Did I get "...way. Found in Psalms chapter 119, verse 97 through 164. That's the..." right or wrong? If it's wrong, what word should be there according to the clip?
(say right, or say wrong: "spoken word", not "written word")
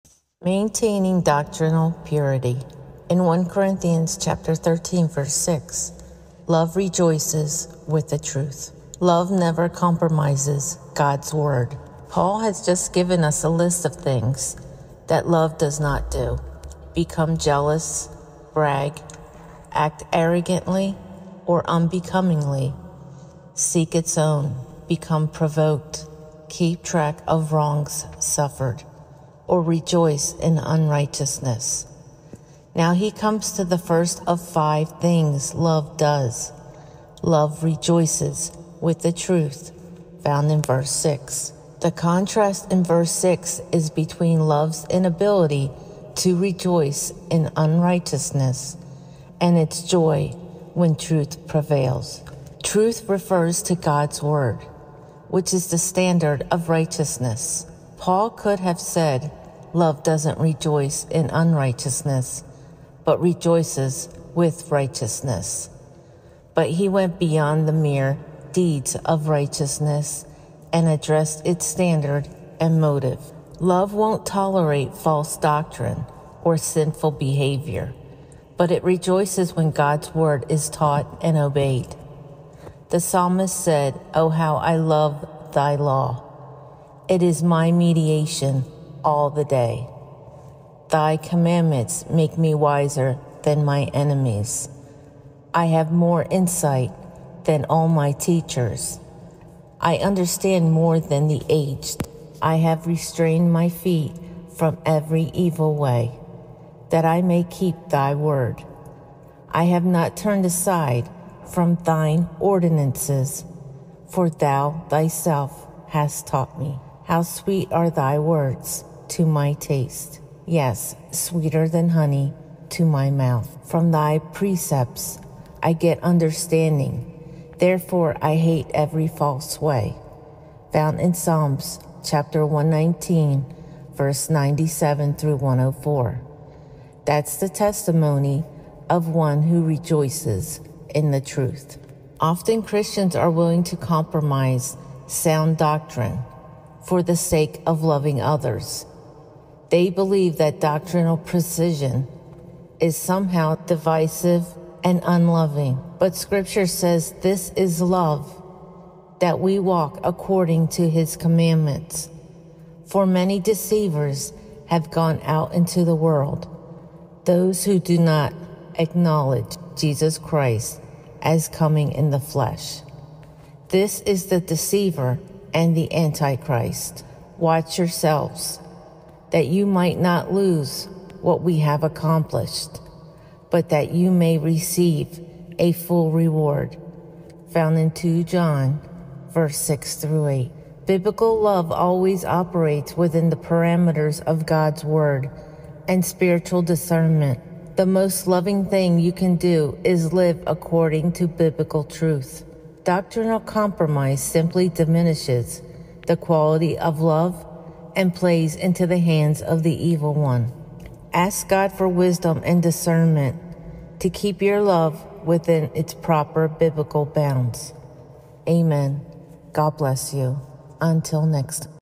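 wrong: "104", not "164".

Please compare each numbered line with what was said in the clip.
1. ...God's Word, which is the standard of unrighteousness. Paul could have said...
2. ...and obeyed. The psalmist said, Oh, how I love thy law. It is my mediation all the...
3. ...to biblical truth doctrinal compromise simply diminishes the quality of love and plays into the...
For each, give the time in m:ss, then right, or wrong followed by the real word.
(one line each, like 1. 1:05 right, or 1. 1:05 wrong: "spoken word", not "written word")
1. 0:53 wrong: "righteousness", not "unrighteousness"
2. 1:21 right
3. 3:21 right.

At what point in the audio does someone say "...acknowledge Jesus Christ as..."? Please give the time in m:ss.
2:48.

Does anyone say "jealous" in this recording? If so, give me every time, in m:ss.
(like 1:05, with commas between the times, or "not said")
0:17.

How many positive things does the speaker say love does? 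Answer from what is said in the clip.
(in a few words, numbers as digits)
5.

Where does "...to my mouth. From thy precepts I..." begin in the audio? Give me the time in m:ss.
2:02.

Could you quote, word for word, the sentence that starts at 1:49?
I have not turned aside from thine ordinances, for thou thyself hast taught me.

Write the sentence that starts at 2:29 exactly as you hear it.
They believe that doctrinal precision is somehow divisive and unloving.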